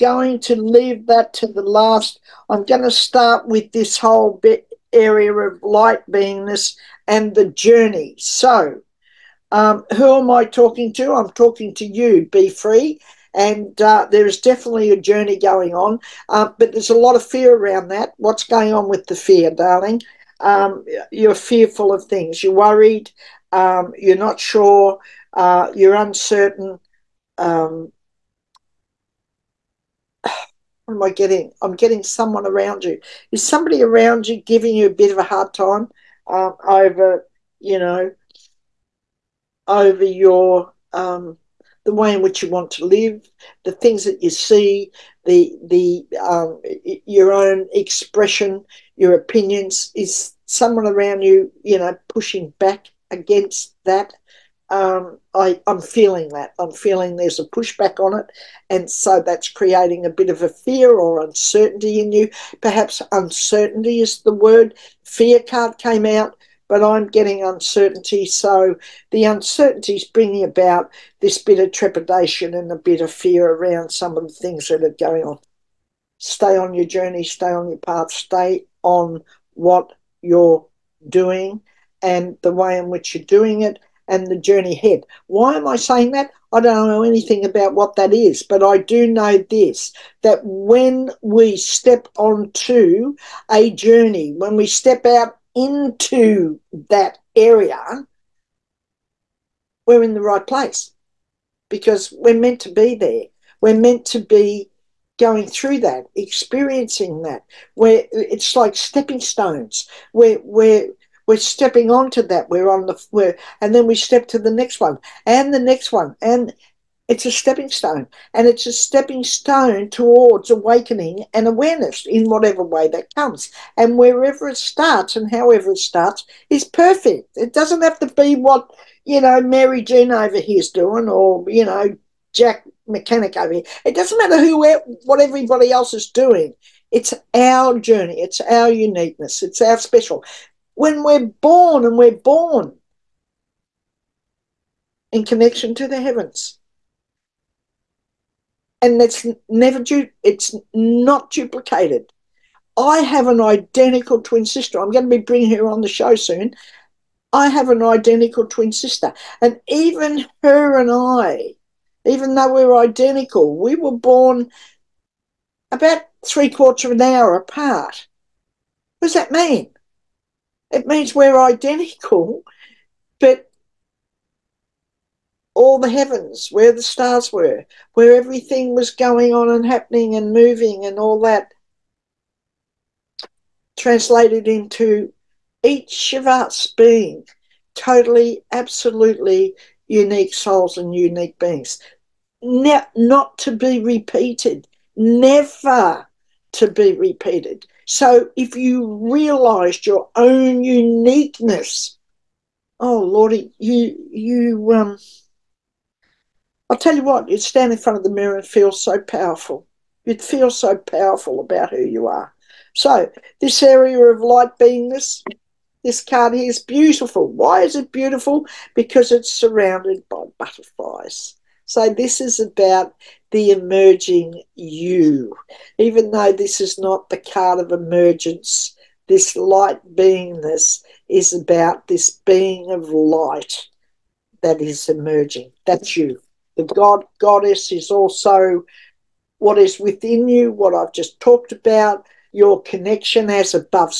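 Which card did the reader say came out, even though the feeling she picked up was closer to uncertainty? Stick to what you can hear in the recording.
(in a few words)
Fear card.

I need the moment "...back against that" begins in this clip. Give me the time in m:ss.
0:52.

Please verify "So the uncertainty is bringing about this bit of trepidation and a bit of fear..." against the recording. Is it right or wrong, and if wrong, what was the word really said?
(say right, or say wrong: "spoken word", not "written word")
right.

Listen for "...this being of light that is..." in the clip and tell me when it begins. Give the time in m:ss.
3:51.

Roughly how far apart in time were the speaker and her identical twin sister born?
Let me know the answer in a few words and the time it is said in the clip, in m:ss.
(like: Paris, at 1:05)
Three quarters of an hour, at 2:46.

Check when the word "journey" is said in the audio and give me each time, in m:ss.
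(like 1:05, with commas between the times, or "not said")
0:07, 0:15, 1:16, 1:24, 1:33, 2:17.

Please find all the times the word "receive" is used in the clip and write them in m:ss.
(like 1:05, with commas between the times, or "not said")
not said.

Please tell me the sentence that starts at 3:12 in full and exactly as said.
Ne- not to be repeated, never to be repeated.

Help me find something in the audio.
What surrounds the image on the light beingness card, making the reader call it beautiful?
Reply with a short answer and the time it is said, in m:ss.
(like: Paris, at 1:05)
Butterflies, at 3:40.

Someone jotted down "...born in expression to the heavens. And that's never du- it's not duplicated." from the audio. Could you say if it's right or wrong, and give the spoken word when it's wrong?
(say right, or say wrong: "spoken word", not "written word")
wrong: "connection", not "expression".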